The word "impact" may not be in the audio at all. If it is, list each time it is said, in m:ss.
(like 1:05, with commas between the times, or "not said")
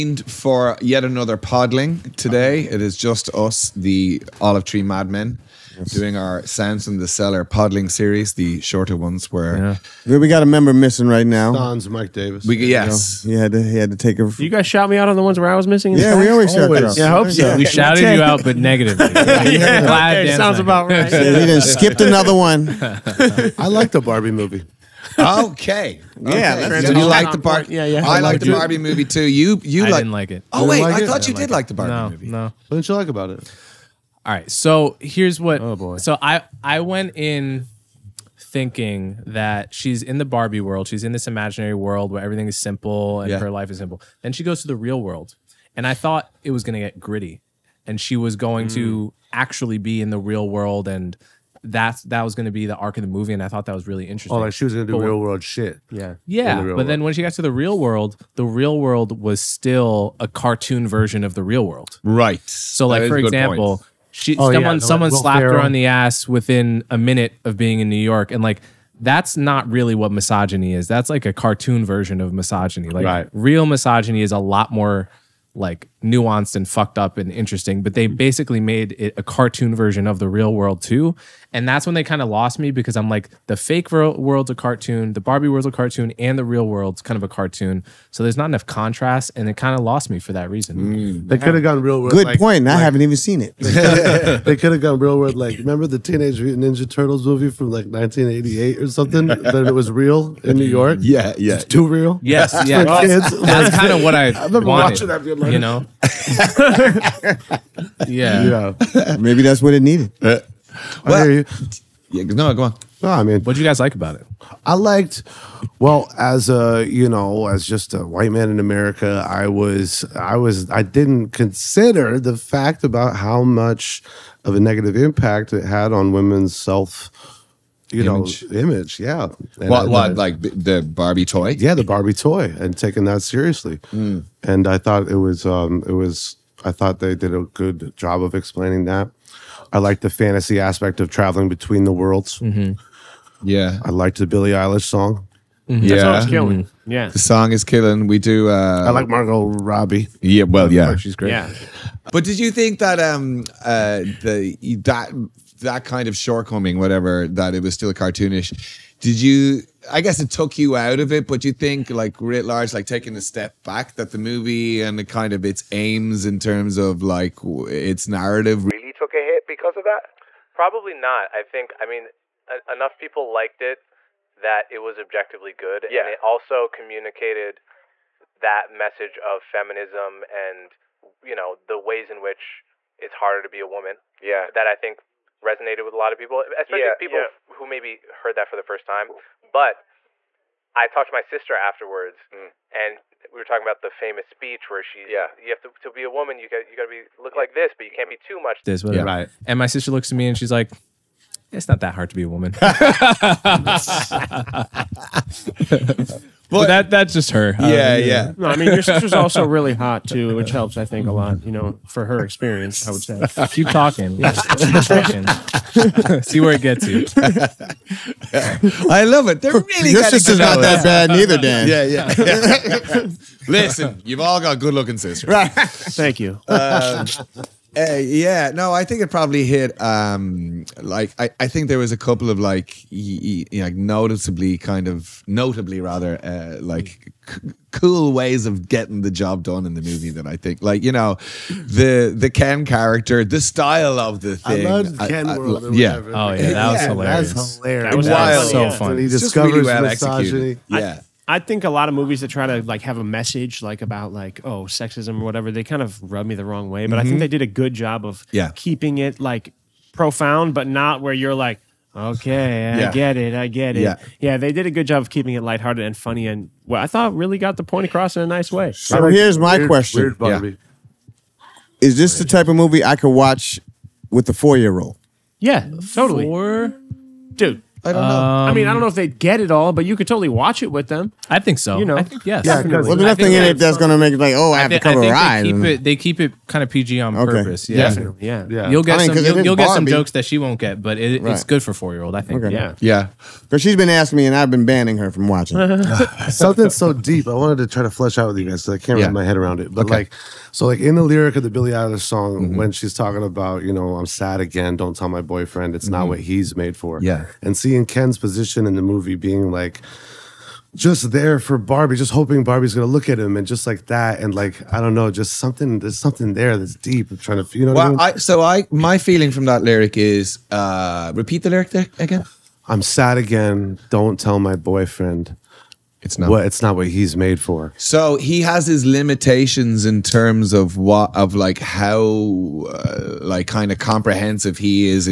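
2:04.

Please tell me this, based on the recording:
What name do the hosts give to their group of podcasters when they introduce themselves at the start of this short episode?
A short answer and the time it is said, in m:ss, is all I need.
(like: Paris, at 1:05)
Olive Tree Madmen, at 0:04.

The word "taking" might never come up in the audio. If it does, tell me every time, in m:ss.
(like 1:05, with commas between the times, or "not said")
2:12, 2:42.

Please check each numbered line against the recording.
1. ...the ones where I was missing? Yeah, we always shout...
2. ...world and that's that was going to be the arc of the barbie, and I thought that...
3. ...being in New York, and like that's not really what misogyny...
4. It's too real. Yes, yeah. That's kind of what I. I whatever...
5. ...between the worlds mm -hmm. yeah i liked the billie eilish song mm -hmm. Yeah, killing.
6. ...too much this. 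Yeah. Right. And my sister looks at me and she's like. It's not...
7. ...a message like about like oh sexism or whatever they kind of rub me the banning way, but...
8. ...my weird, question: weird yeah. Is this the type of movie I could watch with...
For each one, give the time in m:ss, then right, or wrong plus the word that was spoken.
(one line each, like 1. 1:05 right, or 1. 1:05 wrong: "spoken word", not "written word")
1. 0:15 right
2. 0:50 wrong: "movie", not "barbie"
3. 1:07 right
4. 1:41 wrong: "remember", not "whatever"
5. 2:21 right
6. 3:18 right
7. 4:12 wrong: "wrong", not "banning"
8. 4:29 right.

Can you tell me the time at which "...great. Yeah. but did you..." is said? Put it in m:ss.
2:31.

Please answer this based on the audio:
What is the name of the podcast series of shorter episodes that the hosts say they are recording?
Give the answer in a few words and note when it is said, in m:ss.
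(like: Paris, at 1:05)
Sounds in the Cellar, at 0:06.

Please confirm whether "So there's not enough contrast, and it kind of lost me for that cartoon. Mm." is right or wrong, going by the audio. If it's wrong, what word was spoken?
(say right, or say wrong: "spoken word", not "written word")
wrong: "reason", not "cartoon".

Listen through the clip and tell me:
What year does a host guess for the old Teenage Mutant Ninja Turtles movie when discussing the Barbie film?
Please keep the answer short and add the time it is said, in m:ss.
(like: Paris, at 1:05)
1988, at 1:37.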